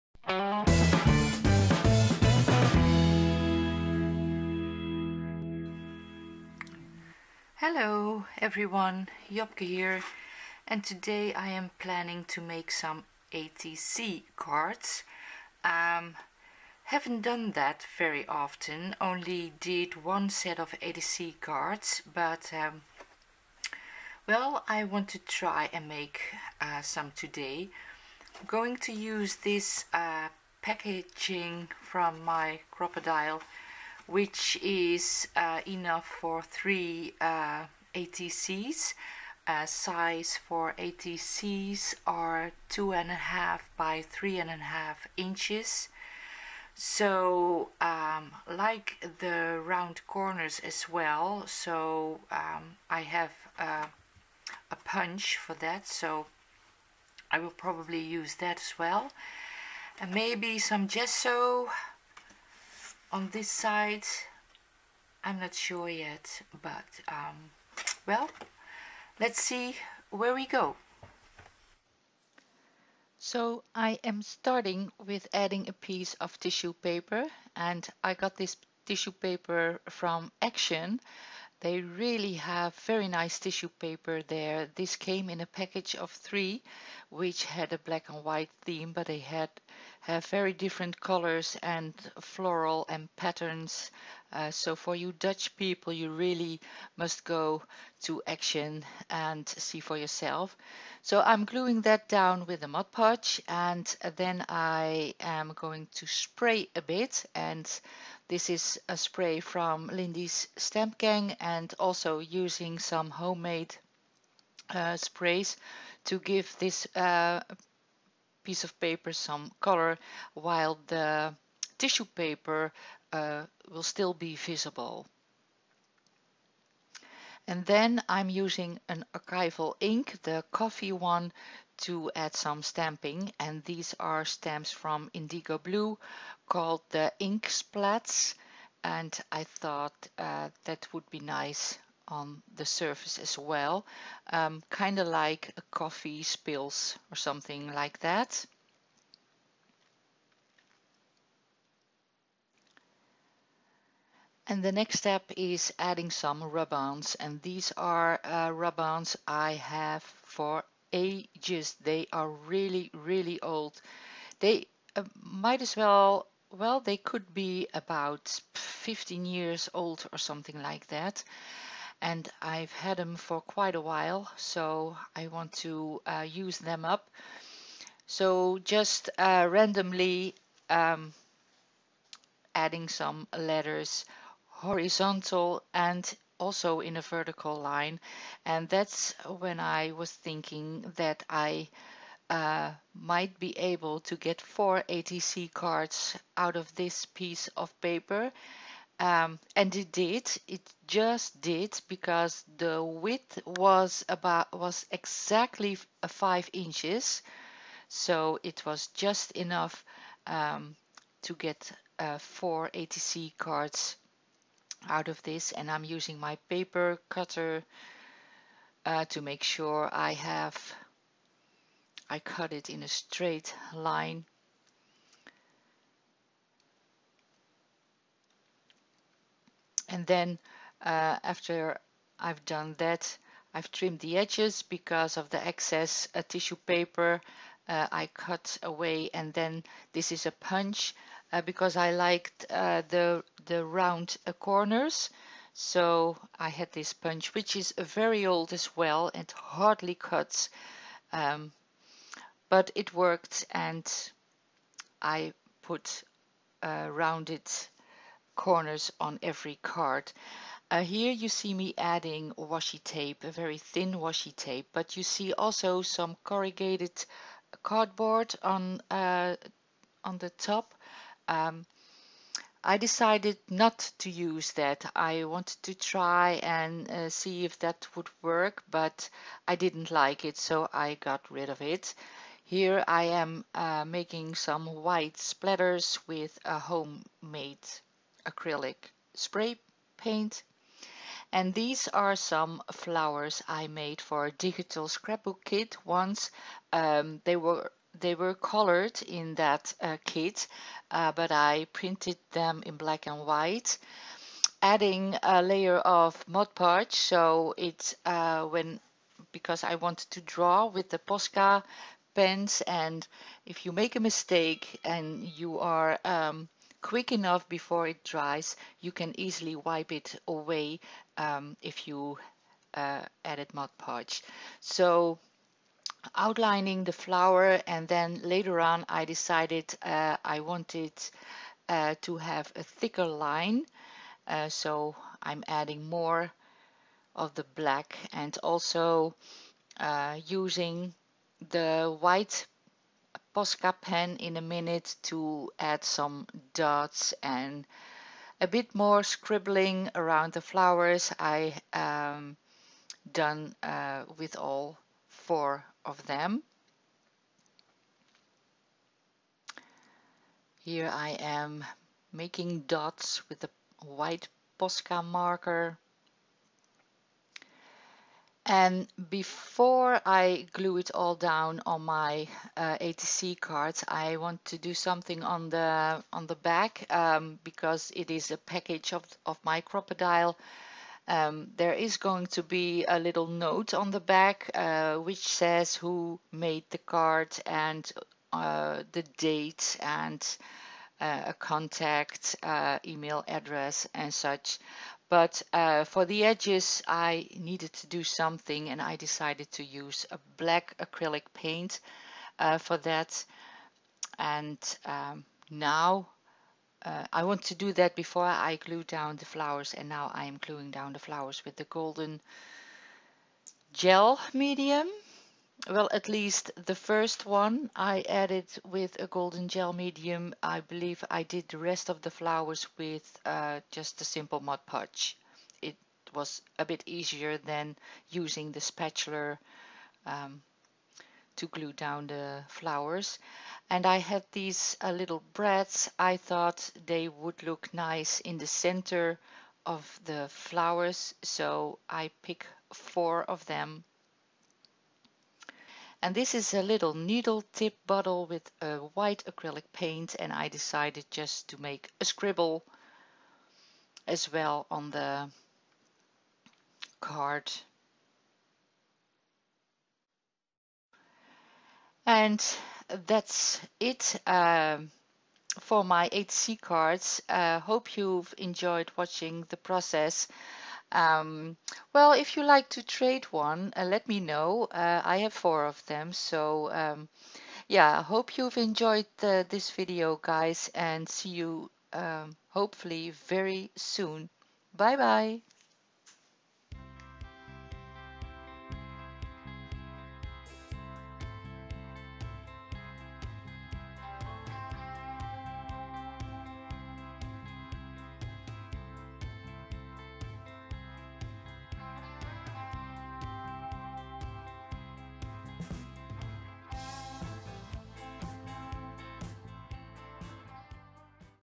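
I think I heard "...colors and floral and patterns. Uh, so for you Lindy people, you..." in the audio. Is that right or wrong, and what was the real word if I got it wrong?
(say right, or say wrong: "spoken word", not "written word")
wrong: "Dutch", not "Lindy".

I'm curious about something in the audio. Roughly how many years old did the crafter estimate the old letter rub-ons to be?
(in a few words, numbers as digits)
15.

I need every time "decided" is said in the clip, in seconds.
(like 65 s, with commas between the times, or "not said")
272 s, 329 s, 398 s, 450 s.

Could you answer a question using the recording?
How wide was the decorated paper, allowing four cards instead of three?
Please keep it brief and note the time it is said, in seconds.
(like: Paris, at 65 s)
5 inches, at 206 s.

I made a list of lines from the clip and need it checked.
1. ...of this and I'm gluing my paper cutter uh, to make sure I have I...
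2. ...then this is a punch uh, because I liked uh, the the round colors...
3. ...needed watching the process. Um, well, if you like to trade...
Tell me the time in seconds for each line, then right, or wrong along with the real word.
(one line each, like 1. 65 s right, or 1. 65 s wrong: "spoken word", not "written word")
1. 215 s wrong: "using", not "gluing"
2. 239 s wrong: "corners", not "colors"
3. 468 s wrong: "enjoyed", not "needed".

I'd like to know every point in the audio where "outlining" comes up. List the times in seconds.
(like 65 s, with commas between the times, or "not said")
326 s.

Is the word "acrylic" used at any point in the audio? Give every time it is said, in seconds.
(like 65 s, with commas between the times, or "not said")
288 s, 400 s, 449 s.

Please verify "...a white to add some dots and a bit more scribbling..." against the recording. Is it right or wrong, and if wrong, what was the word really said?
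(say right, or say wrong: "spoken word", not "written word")
wrong: "minute", not "white".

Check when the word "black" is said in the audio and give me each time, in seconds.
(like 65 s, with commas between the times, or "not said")
87 s, 302 s, 337 s, 400 s.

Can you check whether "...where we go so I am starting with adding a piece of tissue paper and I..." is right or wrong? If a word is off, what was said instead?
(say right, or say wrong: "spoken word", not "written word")
right.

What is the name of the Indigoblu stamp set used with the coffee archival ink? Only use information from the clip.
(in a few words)
Ink Splats.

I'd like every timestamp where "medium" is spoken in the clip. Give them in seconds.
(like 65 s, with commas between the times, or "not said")
414 s, 419 s.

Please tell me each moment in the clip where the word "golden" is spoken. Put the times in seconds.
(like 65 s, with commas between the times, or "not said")
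411 s, 419 s.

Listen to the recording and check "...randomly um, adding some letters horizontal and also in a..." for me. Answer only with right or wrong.
right.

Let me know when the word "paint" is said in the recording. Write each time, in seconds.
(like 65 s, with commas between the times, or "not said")
289 s, 401 s, 449 s.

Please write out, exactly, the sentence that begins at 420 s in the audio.
I believe I did the rest of the flowers with uh, just a simple Mod Podge.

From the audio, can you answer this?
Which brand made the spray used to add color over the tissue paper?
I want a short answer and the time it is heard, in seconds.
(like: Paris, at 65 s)
Lindy's Stamp Gang, at 109 s.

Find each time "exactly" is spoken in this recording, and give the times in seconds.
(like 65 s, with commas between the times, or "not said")
204 s.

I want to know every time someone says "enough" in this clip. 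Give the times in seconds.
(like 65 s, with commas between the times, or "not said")
35 s, 209 s, 317 s.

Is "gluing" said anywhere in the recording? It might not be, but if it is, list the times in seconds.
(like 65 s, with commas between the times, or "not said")
101 s, 410 s.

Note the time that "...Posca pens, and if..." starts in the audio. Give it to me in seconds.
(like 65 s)
310 s.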